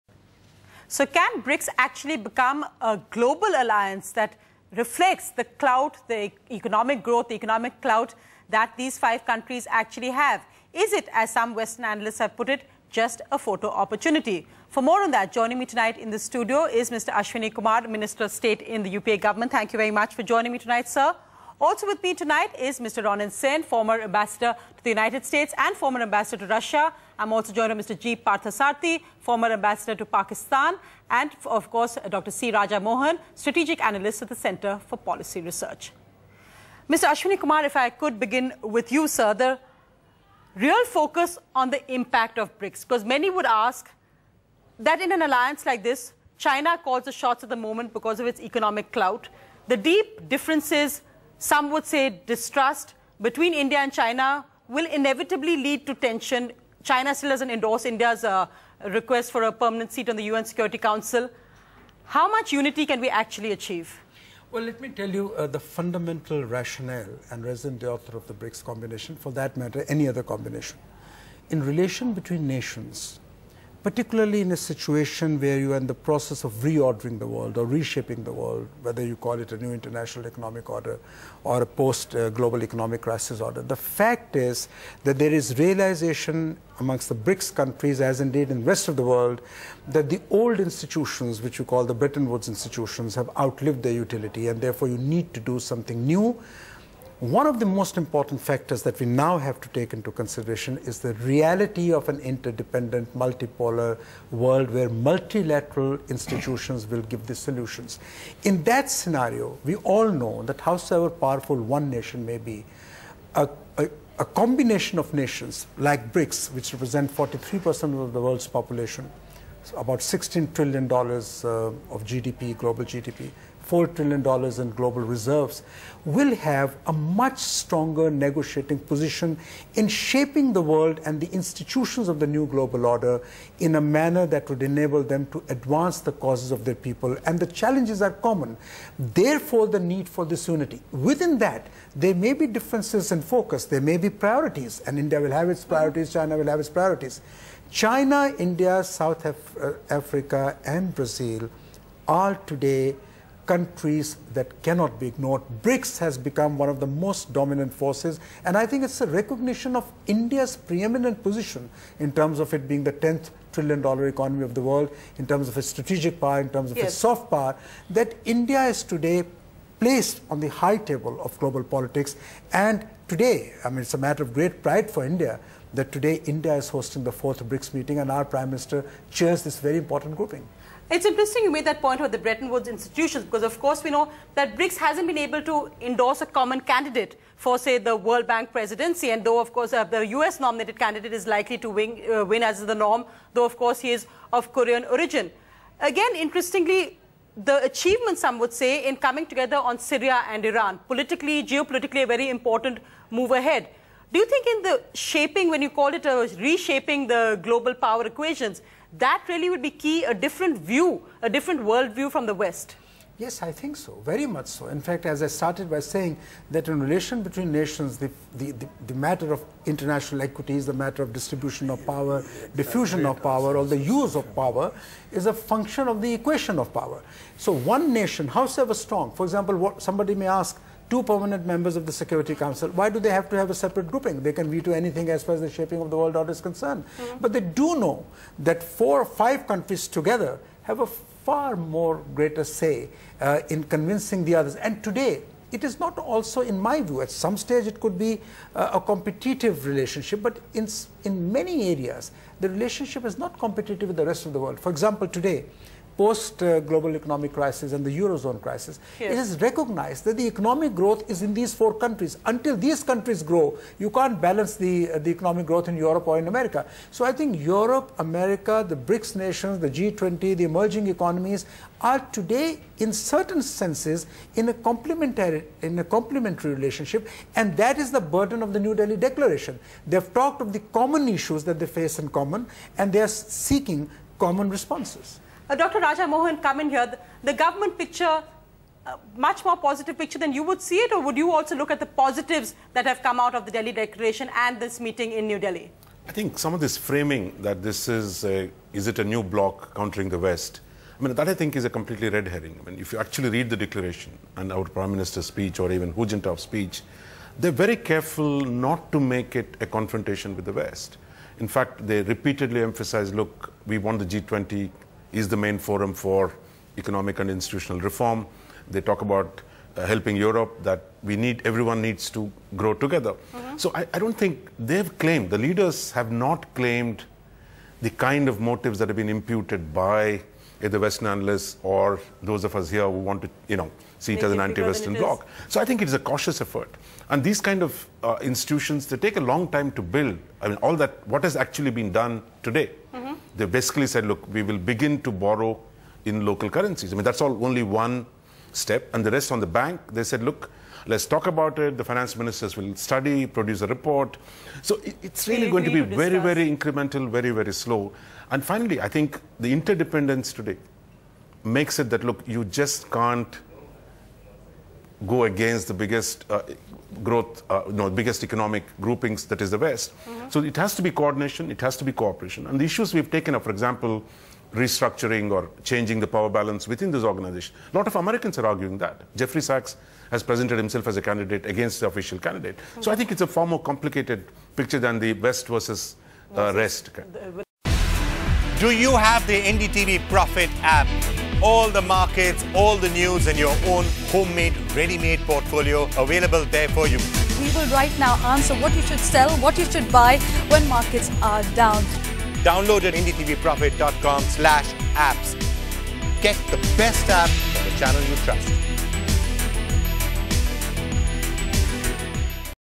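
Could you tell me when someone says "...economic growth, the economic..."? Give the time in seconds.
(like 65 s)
6 s.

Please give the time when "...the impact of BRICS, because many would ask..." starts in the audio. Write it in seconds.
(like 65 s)
41 s.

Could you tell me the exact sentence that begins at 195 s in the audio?
Again, interestingly, the achievement, some would say, in coming together on Syria and Iran, politically, geopolitically, a very important move ahead.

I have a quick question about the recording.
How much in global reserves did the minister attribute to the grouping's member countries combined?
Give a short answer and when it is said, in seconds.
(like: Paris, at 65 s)
$4 trillion, at 123 s.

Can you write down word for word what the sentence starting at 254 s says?
For example, today, post uh, global economic crisis and the eurozone crisis yes.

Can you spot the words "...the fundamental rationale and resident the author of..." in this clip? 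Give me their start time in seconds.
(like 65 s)
65 s.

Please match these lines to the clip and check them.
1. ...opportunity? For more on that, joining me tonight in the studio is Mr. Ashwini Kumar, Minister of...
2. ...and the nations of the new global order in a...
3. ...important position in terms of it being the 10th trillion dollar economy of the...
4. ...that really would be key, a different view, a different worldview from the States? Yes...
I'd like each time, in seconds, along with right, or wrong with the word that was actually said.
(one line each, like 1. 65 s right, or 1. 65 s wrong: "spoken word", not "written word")
1. 13 s right
2. 131 s wrong: "institutions", not "nations"
3. 160 s wrong: "preeminent", not "important"
4. 208 s wrong: "West", not "States".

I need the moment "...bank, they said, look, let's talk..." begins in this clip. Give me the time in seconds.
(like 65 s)
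349 s.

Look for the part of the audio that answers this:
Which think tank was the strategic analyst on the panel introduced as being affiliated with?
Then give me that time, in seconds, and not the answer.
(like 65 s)
34 s.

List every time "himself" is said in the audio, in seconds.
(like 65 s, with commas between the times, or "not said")
380 s.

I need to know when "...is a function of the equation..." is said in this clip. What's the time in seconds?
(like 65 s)
225 s.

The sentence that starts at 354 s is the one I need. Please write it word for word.
So it, it's really going to be to very, very incremental, very, very slow.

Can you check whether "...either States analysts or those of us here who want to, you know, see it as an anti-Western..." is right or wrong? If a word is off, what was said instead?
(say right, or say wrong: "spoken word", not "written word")
wrong: "Western", not "States".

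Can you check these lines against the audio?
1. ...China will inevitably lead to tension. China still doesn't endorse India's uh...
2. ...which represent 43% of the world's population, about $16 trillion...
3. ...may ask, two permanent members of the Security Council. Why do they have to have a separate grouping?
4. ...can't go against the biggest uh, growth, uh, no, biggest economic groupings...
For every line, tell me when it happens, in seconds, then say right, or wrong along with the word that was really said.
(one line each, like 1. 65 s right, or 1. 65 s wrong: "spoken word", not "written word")
1. 53 s right
2. 116 s right
3. 230 s right
4. 362 s right.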